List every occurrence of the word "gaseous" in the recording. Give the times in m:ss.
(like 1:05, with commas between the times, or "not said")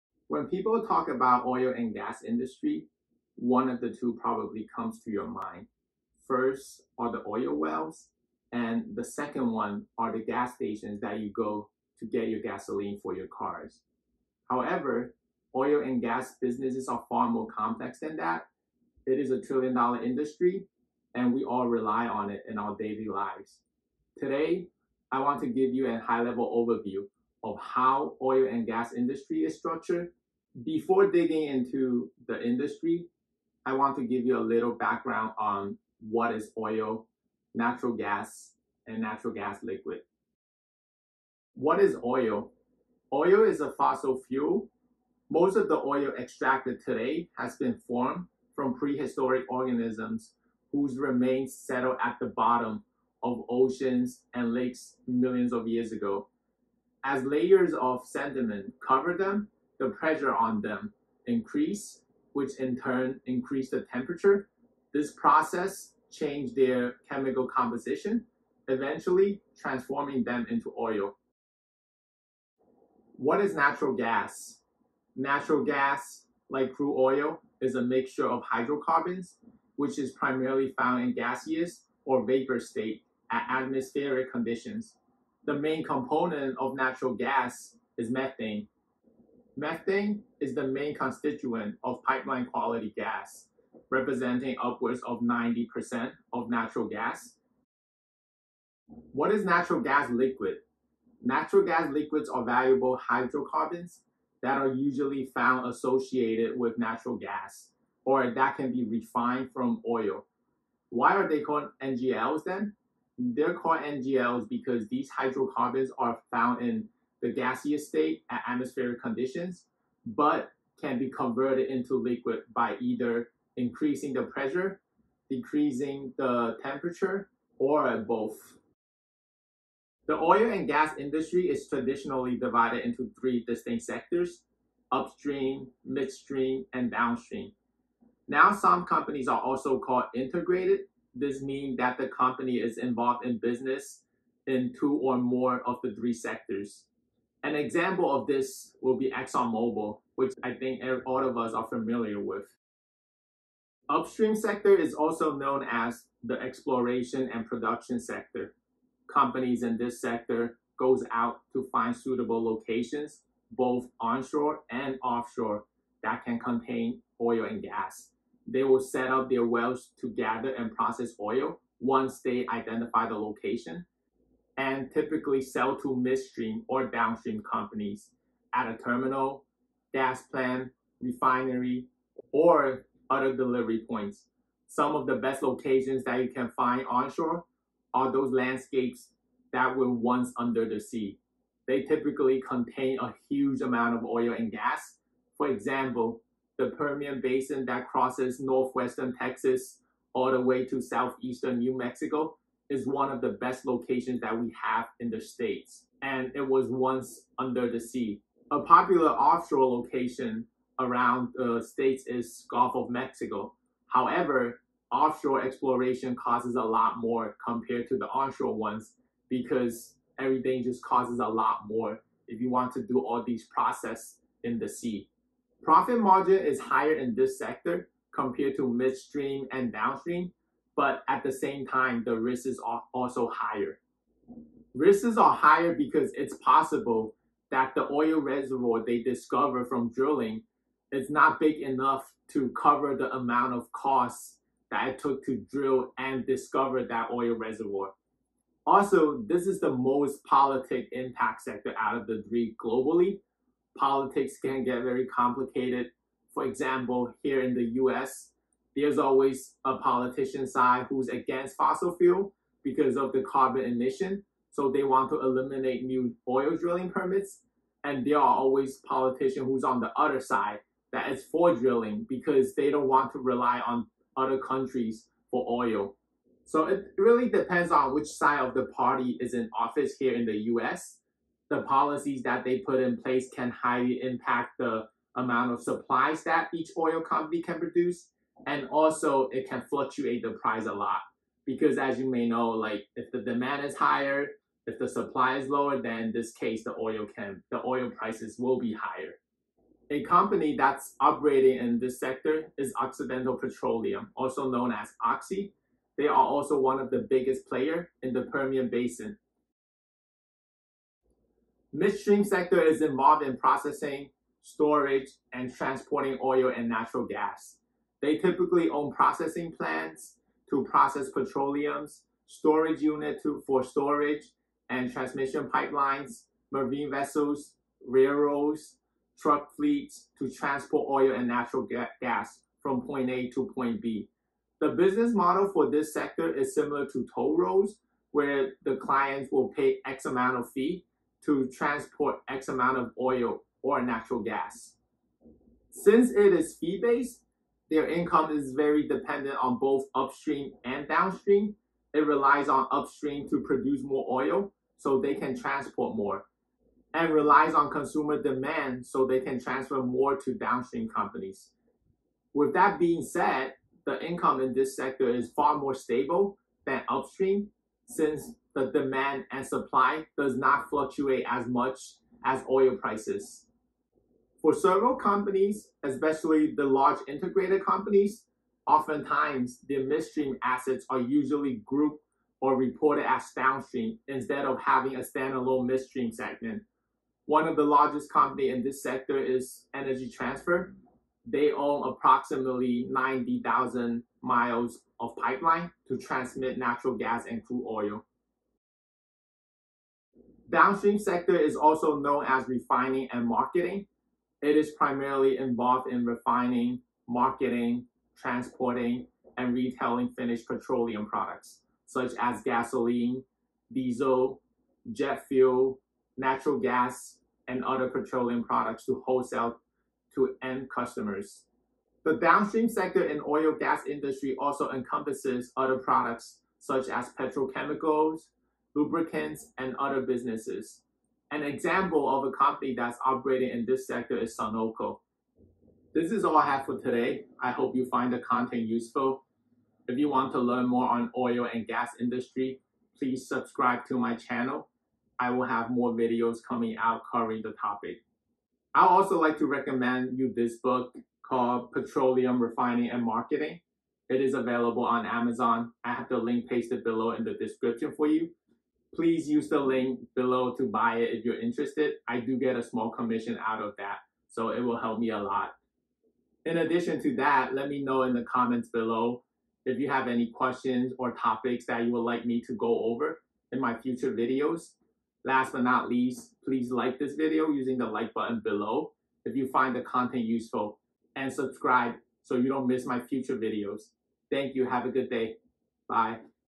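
1:21, 1:57.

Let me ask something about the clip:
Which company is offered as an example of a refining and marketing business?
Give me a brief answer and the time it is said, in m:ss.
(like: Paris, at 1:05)
Sunoco, at 7:14.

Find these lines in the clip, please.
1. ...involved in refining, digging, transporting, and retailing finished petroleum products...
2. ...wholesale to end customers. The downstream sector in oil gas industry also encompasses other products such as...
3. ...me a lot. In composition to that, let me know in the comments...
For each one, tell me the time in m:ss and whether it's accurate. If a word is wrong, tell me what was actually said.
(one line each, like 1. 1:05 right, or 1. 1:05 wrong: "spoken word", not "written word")
1. 6:45 wrong: "marketing", not "digging"
2. 6:59 right
3. 7:44 wrong: "addition", not "composition".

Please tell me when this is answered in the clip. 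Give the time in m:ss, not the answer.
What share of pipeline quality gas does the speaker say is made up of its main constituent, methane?
1:34.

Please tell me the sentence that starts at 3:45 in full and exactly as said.
Profit margin is higher in this sector compared to midstream and downstream but at the same time, the risk is also higher.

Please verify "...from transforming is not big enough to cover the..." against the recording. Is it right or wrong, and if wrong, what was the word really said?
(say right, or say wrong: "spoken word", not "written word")
wrong: "drilling", not "transforming".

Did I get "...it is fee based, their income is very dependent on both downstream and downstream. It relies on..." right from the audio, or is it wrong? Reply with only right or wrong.
wrong.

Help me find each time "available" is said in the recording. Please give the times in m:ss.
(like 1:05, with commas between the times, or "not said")
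7:34.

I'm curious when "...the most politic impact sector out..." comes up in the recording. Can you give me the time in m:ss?
4:09.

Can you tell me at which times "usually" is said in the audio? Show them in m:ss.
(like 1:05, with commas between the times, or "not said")
1:44, 6:20.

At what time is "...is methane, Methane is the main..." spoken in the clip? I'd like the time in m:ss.
1:27.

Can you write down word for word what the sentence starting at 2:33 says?
Upstream sector is also known as the exploration and production sector.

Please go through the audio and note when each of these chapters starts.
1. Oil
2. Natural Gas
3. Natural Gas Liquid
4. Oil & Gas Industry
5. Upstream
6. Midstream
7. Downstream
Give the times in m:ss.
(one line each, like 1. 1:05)
1. 0:40
2. 1:11
3. 1:38
4. 2:09
5. 2:33
6. 5:10
7. 6:39.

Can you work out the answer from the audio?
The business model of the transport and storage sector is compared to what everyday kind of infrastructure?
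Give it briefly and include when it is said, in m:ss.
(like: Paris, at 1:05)
toll roads, at 5:37.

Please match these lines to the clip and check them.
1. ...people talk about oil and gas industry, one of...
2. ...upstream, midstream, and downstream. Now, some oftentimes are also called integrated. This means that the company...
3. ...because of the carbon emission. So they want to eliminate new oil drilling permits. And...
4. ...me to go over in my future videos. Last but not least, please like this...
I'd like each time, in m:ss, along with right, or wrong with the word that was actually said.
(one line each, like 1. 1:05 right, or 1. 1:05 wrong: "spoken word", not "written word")
1. 0:00 right
2. 2:14 wrong: "companies", not "oftentimes"
3. 4:22 right
4. 7:52 right.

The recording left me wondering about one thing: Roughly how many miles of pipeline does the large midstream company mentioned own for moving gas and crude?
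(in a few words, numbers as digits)
90,000.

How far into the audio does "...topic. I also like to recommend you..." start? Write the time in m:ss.
7:27.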